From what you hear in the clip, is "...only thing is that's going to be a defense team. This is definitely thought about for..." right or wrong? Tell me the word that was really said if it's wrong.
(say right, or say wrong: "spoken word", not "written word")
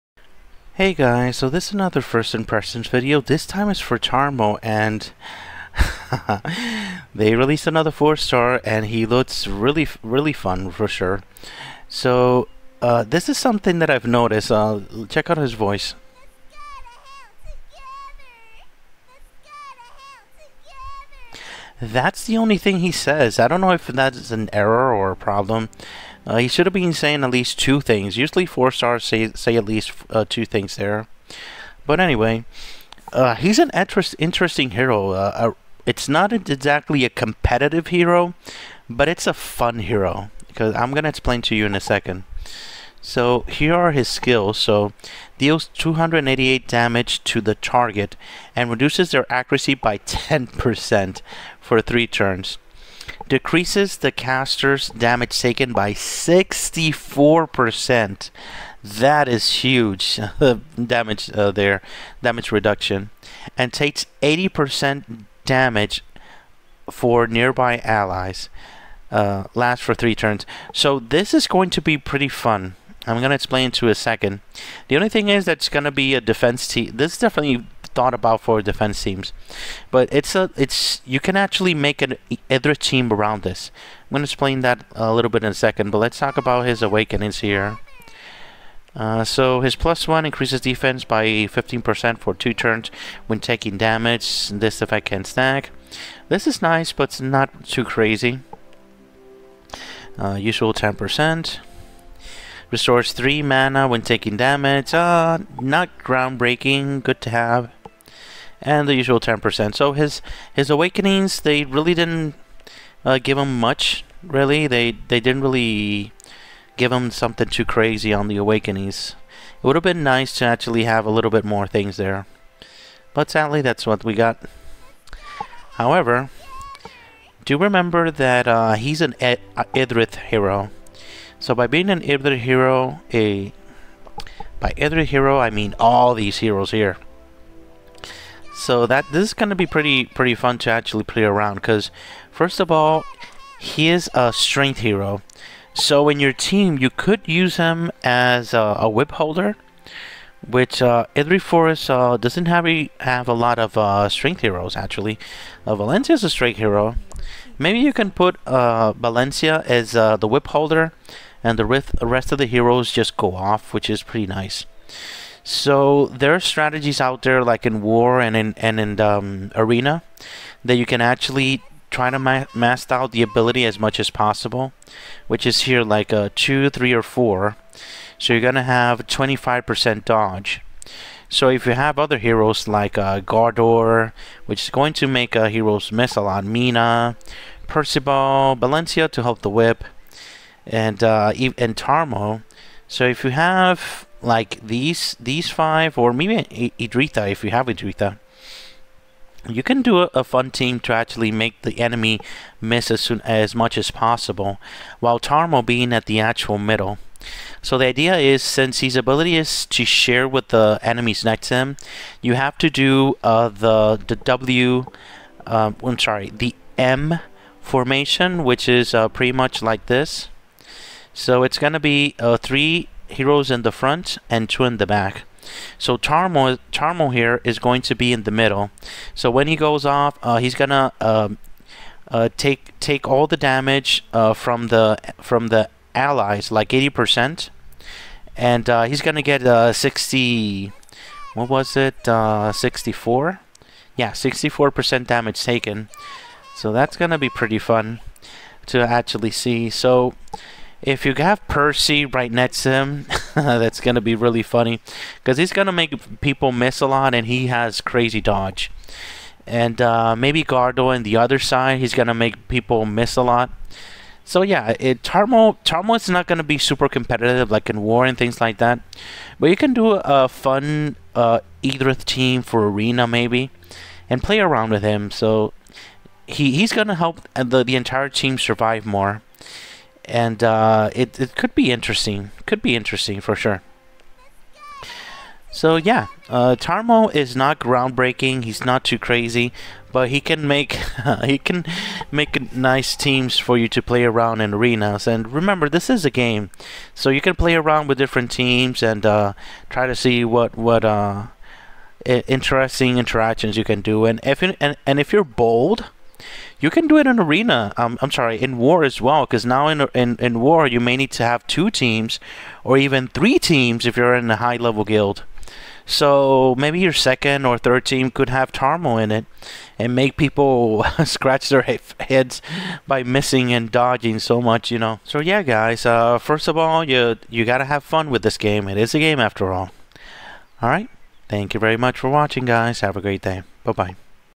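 right.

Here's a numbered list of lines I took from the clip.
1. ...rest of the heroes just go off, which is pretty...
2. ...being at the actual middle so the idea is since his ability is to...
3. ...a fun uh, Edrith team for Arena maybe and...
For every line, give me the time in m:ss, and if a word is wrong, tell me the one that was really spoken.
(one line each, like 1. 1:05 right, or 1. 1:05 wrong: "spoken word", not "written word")
1. 2:41 right
2. 3:25 right
3. 4:29 right.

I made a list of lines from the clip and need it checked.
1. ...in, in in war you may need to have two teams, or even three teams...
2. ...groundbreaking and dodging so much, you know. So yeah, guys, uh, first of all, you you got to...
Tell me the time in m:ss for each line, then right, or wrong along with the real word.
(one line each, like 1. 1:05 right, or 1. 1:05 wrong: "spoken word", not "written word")
1. 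5:09 right
2. 5:23 wrong: "missing", not "groundbreaking".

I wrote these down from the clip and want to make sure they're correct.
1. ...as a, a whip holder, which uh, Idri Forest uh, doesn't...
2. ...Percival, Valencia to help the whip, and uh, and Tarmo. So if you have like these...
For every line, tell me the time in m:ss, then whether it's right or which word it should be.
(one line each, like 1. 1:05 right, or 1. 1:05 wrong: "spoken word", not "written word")
1. 2:28 right
2. 3:07 right.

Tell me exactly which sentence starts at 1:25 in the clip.
But let's talk about his awakenings here.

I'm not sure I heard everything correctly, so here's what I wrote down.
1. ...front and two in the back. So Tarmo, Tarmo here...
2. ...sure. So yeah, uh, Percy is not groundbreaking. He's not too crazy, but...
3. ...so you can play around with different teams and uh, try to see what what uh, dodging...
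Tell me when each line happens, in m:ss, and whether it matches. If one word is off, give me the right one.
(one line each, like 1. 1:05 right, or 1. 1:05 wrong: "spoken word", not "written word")
1. 3:43 right
2. 4:43 wrong: "Tarmo", not "Percy"
3. 4:56 wrong: "interesting", not "dodging".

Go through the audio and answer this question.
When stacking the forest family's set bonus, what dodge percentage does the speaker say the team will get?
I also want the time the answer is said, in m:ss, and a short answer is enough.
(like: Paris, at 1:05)
25%, at 2:59.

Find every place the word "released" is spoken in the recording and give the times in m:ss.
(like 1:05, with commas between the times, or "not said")
0:07.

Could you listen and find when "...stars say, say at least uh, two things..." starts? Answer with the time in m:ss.
0:28.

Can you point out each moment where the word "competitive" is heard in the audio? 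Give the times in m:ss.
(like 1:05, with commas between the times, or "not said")
0:37, 4:26.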